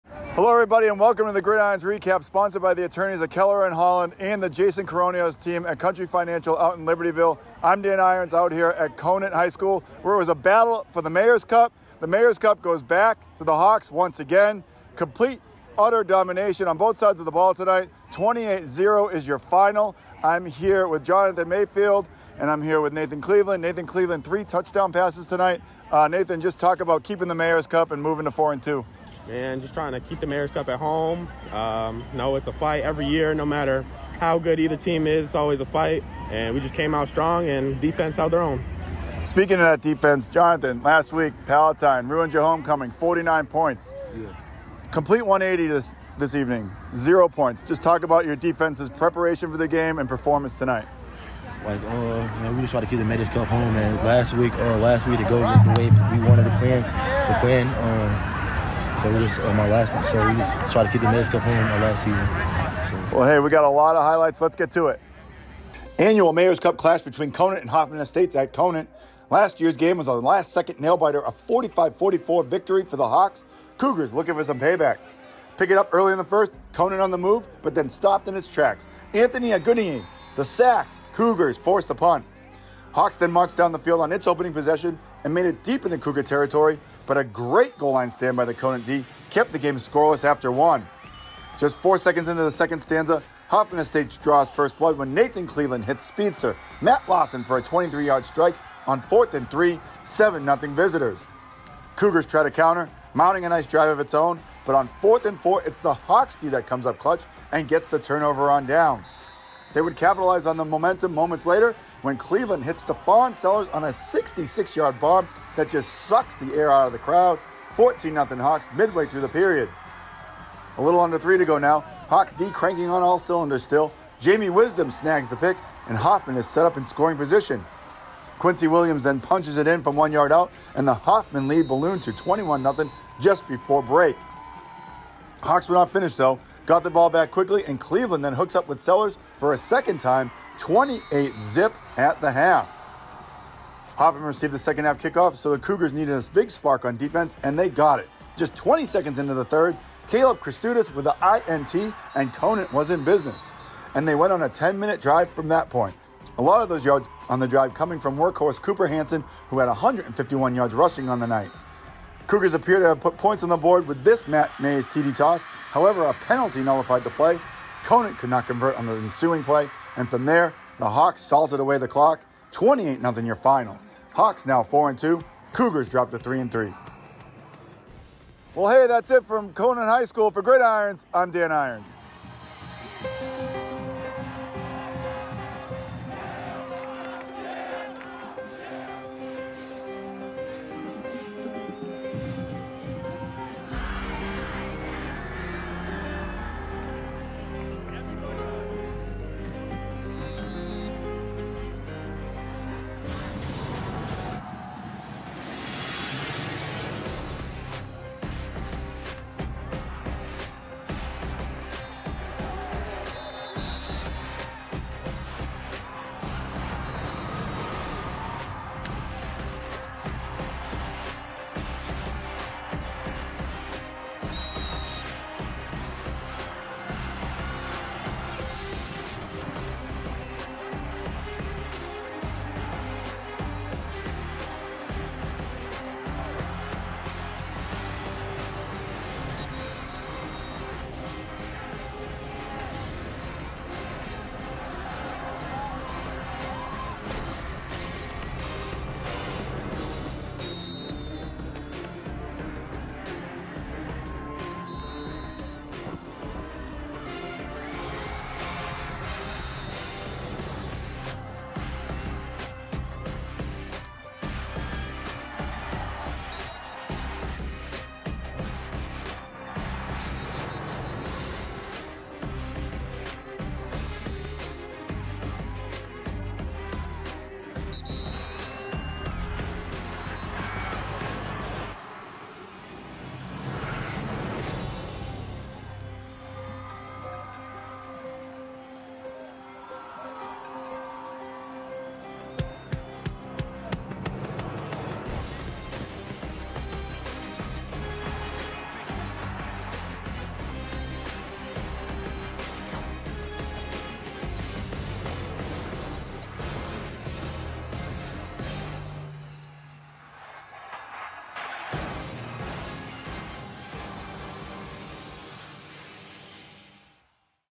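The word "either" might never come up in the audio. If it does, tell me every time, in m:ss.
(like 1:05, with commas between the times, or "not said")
0:34.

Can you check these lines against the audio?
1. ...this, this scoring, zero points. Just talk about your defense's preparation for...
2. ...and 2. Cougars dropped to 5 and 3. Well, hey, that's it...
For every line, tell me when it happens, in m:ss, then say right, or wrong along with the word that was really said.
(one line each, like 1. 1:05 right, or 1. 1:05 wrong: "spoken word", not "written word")
1. 0:45 wrong: "evening", not "scoring"
2. 2:54 wrong: "3", not "5".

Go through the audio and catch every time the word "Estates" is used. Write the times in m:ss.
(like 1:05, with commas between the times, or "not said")
1:07, 1:33.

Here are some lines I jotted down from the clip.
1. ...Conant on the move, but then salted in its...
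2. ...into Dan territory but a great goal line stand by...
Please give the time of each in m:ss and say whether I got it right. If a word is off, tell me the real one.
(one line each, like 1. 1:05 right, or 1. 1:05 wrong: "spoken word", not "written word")
1. 1:16 wrong: "stopped", not "salted"
2. 1:25 wrong: "Cougar", not "Dan".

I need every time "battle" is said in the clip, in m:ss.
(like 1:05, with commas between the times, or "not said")
0:10.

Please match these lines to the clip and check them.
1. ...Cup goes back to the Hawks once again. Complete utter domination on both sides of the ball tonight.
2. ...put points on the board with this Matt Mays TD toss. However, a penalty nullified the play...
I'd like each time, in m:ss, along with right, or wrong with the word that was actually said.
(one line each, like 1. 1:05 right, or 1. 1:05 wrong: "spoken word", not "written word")
1. 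0:12 right
2. 2:43 right.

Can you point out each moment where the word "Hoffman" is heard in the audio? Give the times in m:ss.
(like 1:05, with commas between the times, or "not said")
1:07, 1:33, 2:05, 2:10, 2:23.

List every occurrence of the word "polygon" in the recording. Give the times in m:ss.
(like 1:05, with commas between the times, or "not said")
not said.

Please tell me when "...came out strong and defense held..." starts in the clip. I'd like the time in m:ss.
0:36.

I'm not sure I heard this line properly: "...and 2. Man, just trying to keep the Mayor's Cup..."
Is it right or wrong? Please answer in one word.
right.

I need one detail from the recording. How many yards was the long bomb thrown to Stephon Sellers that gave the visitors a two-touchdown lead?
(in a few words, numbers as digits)
66.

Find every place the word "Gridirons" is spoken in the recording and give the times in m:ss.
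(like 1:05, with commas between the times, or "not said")
0:01, 3:00.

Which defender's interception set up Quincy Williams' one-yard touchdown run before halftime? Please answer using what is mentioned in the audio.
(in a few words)
Jamie Wisdom.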